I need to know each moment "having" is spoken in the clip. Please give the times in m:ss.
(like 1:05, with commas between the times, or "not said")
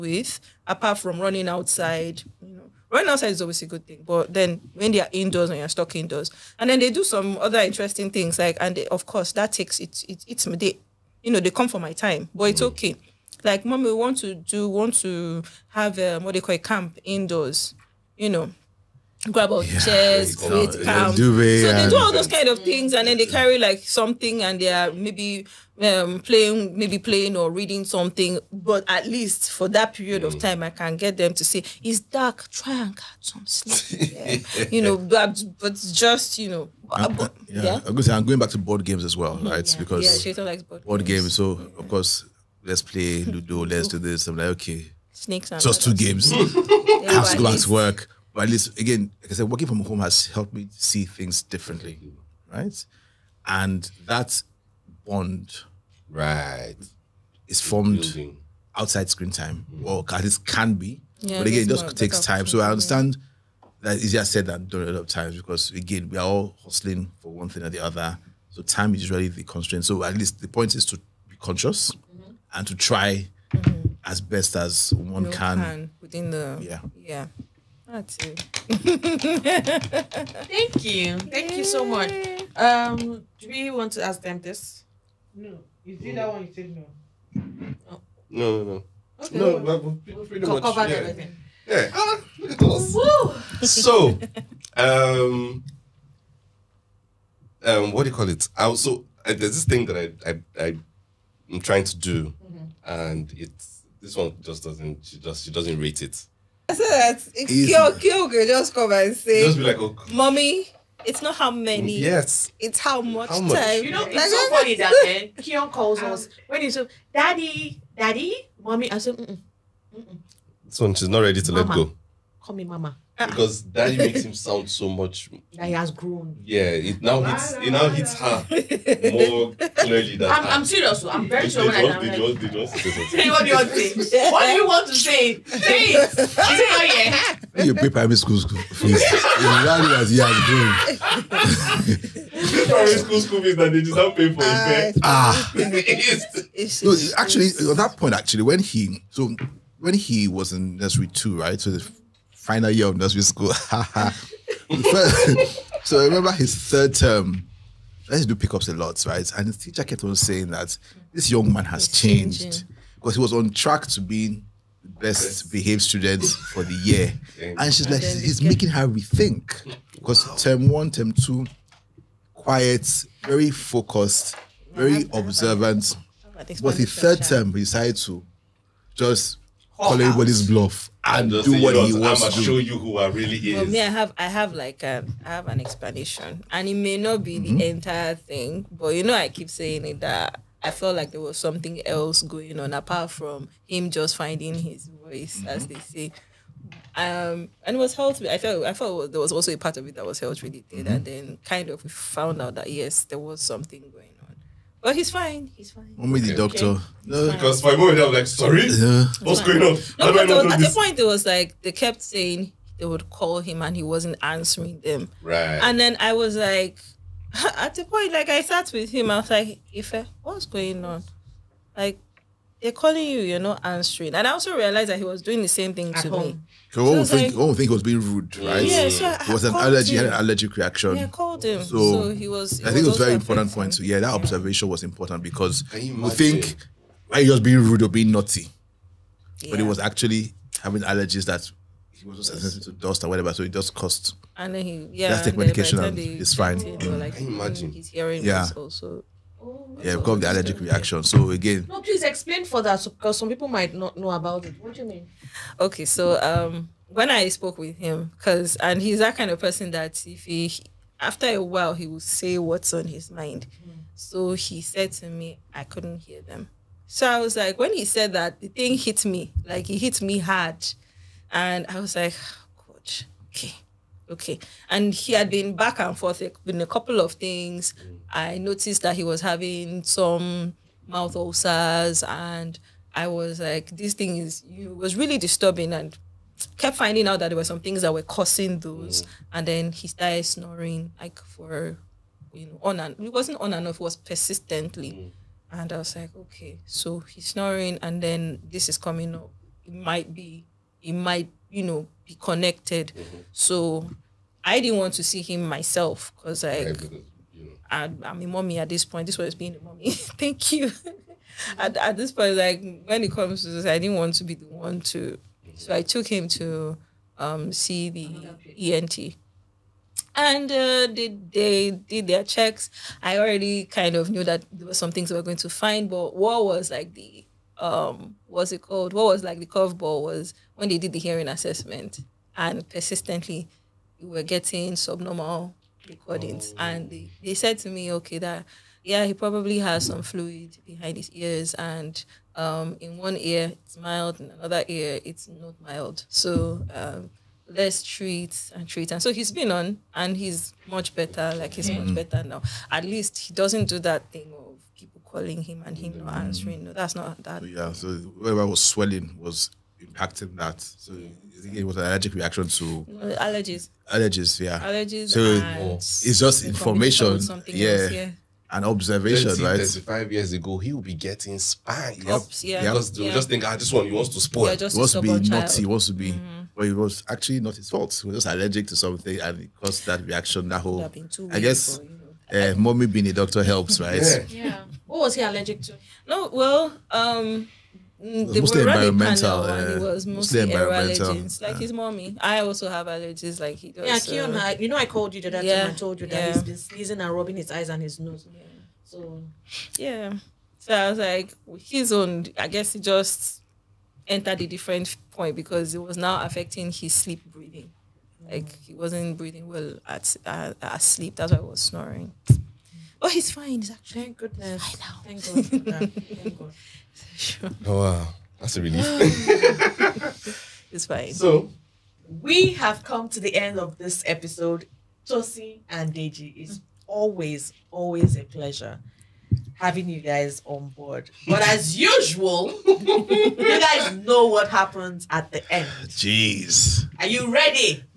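4:00, 4:39, 7:09.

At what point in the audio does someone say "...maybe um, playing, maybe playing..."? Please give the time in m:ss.
0:24.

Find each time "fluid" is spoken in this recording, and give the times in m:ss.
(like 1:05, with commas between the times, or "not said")
5:40.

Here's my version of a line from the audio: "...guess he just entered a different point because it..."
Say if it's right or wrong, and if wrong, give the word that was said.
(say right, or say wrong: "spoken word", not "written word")
right.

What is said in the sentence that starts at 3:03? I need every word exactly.
For me, I have I have like a, um, I I have an explanation, and it may not be mm-hmm.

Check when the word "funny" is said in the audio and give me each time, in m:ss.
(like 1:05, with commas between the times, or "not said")
1:54.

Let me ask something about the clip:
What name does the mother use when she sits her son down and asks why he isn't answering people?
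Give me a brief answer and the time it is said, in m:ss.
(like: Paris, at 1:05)
Ife, at 3:39.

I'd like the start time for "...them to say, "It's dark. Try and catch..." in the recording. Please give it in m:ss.
0:31.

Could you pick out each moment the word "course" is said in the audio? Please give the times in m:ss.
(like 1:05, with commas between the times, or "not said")
0:09, 0:41.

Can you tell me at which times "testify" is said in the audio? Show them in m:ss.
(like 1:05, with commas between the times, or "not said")
not said.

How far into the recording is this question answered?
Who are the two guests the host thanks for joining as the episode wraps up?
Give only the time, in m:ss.
7:05.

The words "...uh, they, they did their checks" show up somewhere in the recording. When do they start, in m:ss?
5:20.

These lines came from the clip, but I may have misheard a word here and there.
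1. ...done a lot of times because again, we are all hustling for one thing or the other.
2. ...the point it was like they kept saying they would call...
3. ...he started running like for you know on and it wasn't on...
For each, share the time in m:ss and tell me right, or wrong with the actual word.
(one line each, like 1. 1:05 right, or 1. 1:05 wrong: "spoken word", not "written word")
1. 1:04 right
2. 3:30 right
3. 4:49 wrong: "snoring", not "running".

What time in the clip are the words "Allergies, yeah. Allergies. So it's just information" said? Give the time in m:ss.
6:03.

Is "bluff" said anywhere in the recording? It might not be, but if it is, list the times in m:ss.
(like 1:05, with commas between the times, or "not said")
3:00.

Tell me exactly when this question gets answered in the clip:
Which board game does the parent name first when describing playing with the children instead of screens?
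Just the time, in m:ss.
0:43.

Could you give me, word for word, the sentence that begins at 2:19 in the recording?
In reality, as he has grown.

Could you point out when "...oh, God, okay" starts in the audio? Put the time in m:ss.
4:32.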